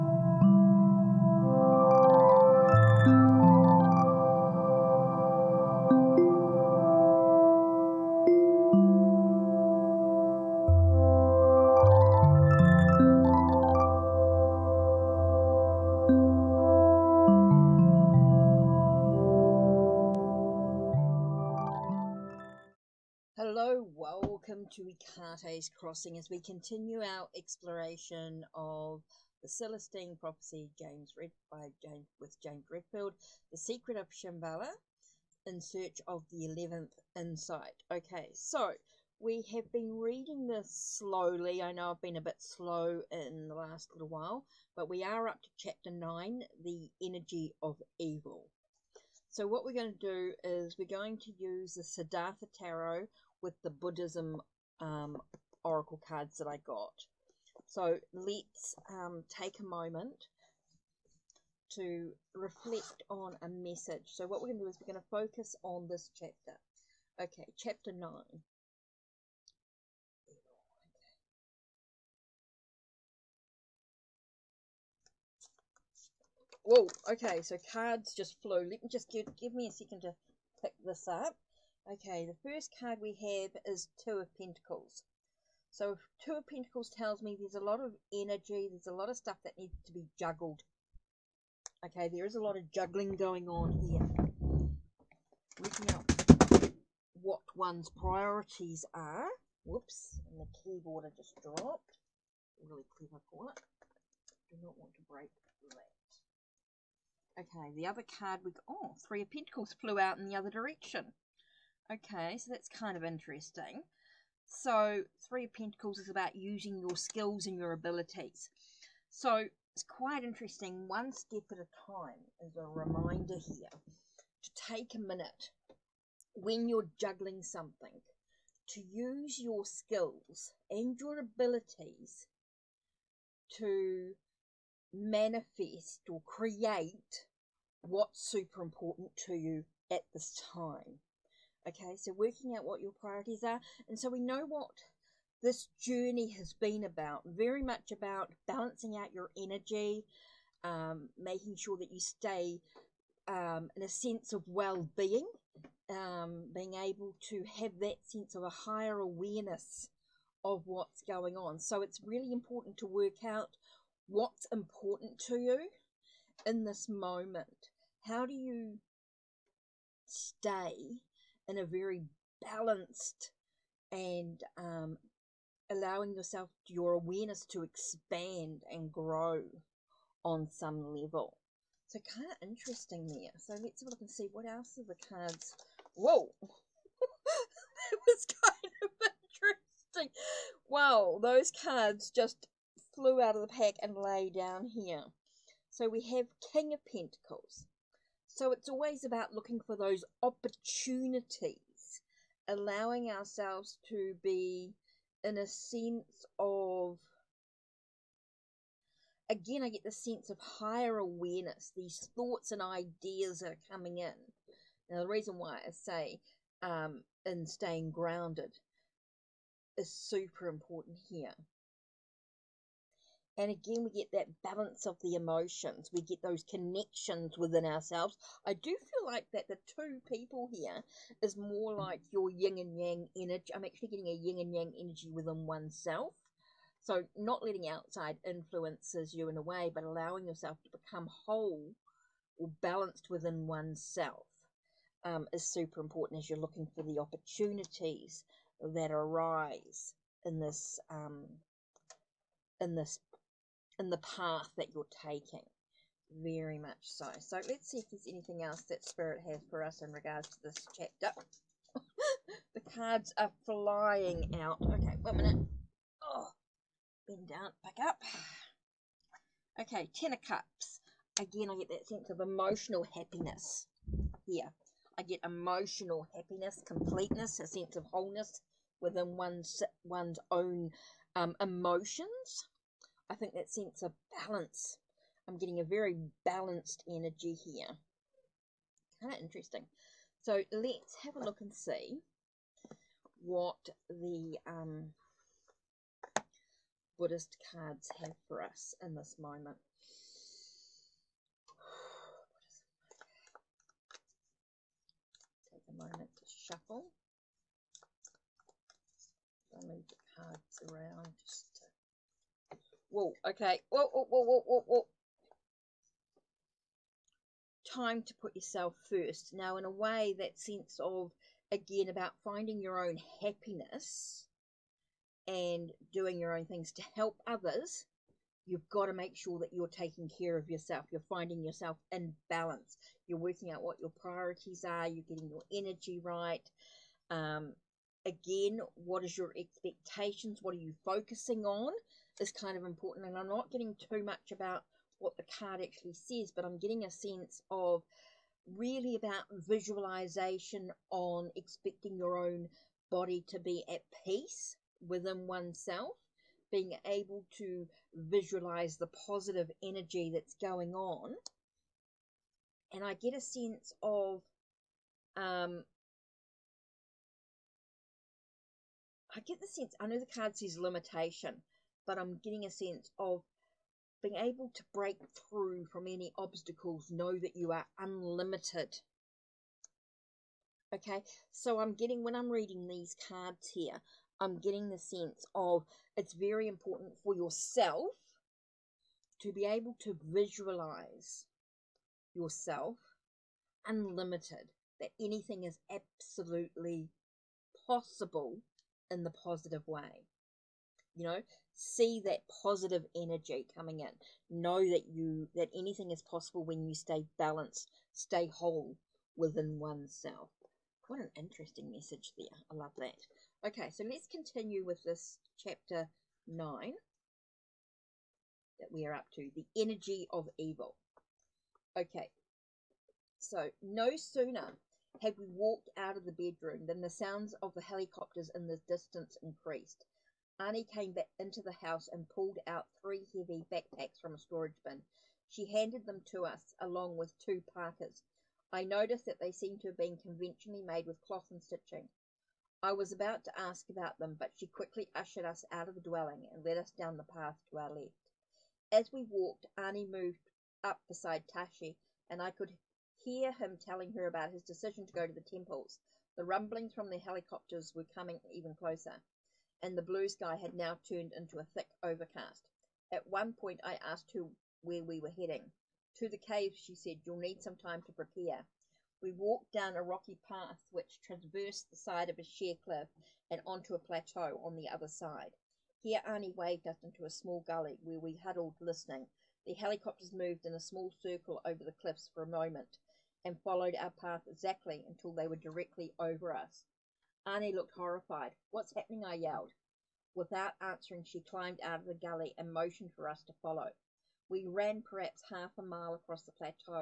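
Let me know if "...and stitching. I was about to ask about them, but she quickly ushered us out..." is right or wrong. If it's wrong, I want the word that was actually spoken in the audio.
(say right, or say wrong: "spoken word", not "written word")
right.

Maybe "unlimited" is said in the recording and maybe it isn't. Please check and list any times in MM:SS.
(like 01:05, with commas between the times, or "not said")
06:17, 06:33.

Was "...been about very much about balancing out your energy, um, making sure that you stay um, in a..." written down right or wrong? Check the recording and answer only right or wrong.
right.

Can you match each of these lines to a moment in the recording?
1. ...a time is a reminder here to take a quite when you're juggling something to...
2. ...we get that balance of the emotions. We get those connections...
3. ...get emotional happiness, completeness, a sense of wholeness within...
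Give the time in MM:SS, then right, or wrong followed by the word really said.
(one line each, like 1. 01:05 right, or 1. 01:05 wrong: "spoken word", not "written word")
1. 02:01 wrong: "minute", not "quite"
2. 03:43 right
3. 04:35 right.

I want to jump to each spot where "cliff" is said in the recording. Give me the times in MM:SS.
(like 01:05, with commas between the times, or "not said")
07:52, 08:01.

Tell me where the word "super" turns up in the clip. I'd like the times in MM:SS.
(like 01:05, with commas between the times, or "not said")
02:18, 03:39, 04:05.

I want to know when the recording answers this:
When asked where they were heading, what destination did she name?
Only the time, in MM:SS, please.
07:46.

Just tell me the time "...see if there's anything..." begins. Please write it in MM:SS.
04:17.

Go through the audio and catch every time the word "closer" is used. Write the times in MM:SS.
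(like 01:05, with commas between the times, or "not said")
07:38.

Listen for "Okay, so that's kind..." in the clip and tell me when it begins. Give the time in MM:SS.
01:51.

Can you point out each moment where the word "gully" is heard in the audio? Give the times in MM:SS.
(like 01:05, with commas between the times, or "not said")
07:57, 08:11.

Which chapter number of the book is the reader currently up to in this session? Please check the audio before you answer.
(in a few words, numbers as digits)
9.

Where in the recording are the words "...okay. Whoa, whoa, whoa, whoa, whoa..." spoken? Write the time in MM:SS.
05:13.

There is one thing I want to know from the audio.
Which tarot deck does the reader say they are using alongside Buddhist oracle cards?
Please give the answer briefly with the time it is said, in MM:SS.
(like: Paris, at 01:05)
Siddhartha Tarot, at 00:51.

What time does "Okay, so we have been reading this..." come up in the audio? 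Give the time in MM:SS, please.
00:37.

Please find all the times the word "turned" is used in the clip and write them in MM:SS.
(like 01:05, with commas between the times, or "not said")
07:40.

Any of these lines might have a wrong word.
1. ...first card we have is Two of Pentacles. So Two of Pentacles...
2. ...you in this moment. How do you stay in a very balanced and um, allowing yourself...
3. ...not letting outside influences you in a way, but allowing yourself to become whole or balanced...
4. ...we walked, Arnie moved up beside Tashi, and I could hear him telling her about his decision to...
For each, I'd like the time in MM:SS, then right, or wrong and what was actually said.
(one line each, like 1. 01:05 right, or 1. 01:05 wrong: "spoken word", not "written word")
1. 01:22 right
2. 02:45 right
3. 03:57 right
4. 07:28 right.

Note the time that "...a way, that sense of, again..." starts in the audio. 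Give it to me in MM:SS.
05:19.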